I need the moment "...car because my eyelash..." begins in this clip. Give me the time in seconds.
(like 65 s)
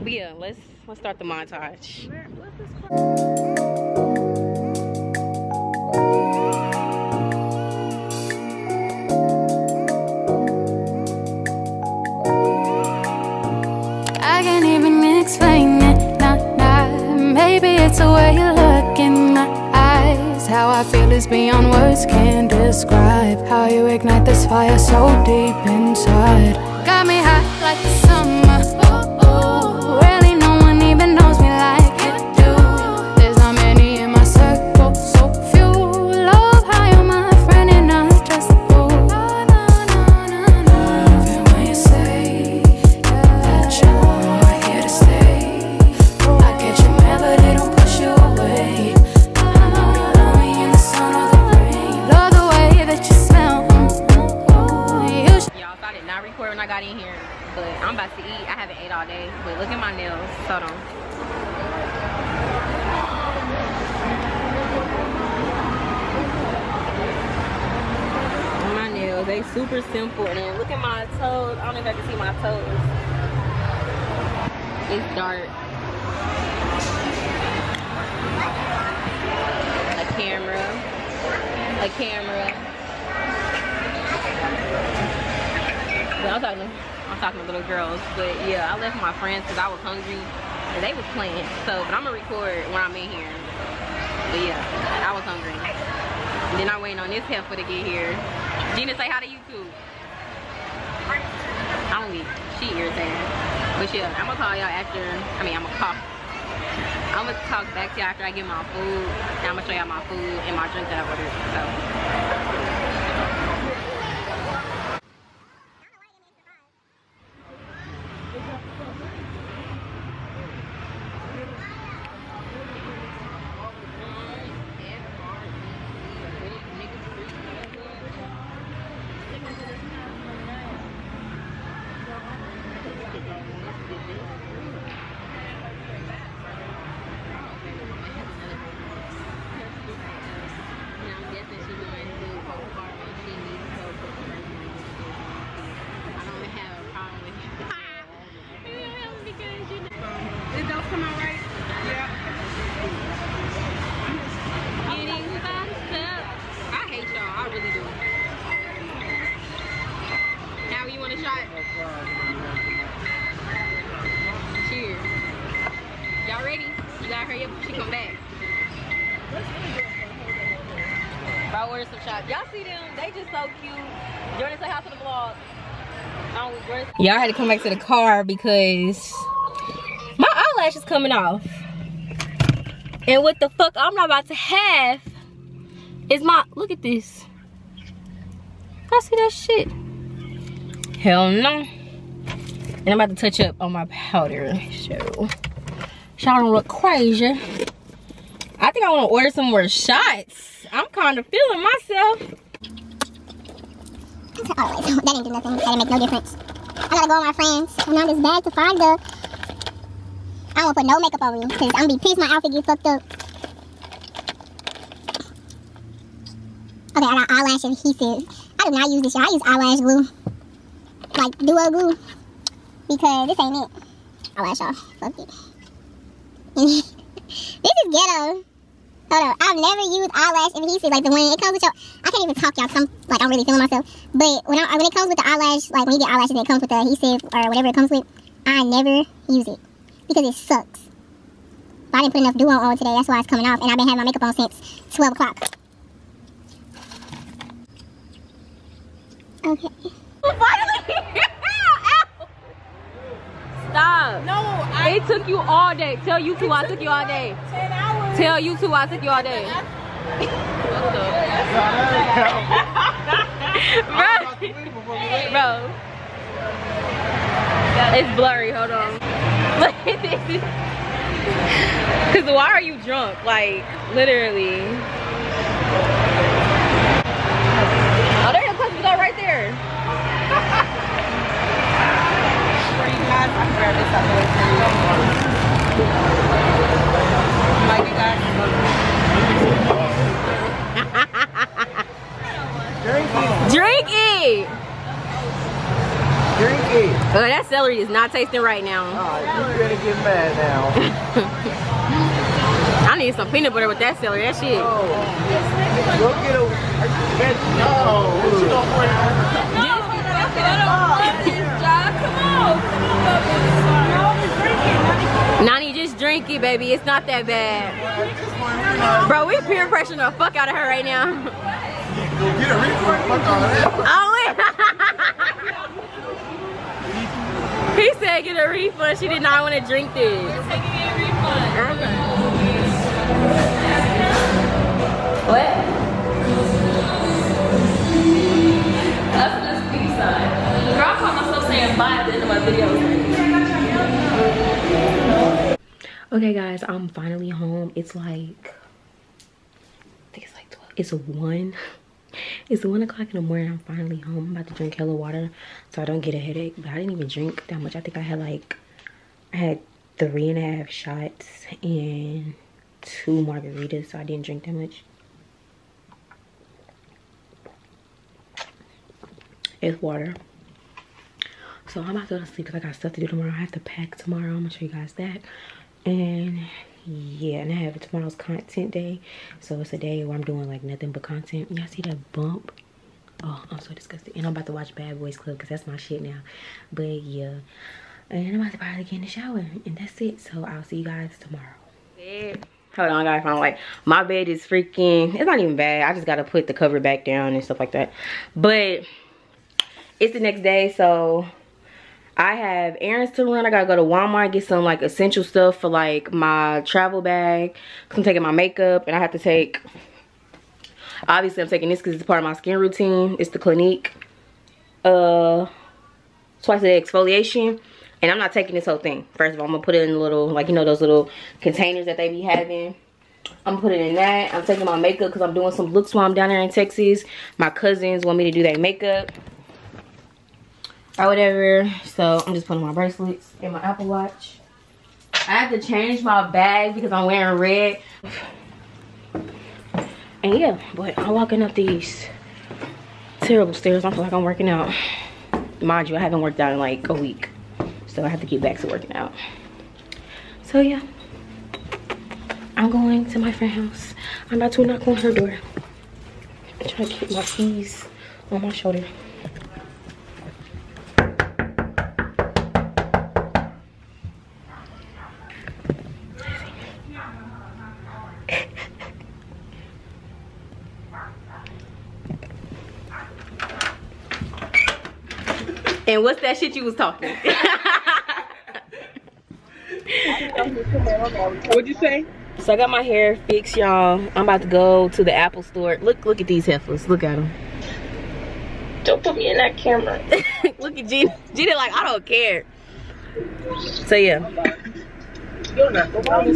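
177 s.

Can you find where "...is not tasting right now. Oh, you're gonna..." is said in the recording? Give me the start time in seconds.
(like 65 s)
297 s.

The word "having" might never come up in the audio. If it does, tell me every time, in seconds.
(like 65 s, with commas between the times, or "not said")
243 s, 422 s.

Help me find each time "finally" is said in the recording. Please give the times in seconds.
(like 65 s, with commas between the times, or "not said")
346 s, 353 s.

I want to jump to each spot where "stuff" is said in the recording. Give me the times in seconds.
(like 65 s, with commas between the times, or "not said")
372 s, 397 s, 405 s.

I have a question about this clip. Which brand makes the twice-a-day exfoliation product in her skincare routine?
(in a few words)
Clinique.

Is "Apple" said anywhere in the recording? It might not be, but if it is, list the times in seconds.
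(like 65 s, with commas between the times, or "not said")
433 s, 485 s.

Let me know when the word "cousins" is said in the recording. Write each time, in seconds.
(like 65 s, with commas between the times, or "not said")
427 s.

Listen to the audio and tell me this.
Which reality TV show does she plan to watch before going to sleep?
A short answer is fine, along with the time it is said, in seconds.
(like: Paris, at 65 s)
Bad Boys Club, at 384 s.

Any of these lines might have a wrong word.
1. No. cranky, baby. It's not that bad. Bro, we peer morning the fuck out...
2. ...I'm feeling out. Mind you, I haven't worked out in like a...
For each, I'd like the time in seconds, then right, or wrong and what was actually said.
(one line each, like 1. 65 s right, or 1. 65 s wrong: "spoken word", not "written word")
1. 309 s wrong: "pressuring", not "morning"
2. 444 s wrong: "working", not "feeling".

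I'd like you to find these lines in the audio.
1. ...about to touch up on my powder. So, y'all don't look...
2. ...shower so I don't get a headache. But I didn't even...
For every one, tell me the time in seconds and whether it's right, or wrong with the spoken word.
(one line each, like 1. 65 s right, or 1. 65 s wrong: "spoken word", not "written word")
1. 193 s right
2. 354 s wrong: "water", not "shower".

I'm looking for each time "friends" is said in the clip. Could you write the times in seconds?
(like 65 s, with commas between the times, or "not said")
89 s, 207 s, 453 s.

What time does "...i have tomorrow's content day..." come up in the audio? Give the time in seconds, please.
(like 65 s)
377 s.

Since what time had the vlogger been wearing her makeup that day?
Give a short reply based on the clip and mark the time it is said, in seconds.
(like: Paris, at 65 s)
12 o'clock, at 244 s.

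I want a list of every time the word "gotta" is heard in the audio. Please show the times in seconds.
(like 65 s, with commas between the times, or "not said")
206 s, 396 s, 403 s.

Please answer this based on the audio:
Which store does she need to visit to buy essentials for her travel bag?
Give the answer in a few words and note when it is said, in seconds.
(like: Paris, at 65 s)
Walmart, at 403 s.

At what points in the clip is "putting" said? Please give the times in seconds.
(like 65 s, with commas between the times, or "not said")
423 s, 432 s.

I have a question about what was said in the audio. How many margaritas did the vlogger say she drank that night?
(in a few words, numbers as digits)
2.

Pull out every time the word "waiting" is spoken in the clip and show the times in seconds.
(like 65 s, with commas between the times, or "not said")
96 s.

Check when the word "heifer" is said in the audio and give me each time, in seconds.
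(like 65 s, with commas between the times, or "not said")
97 s, 486 s.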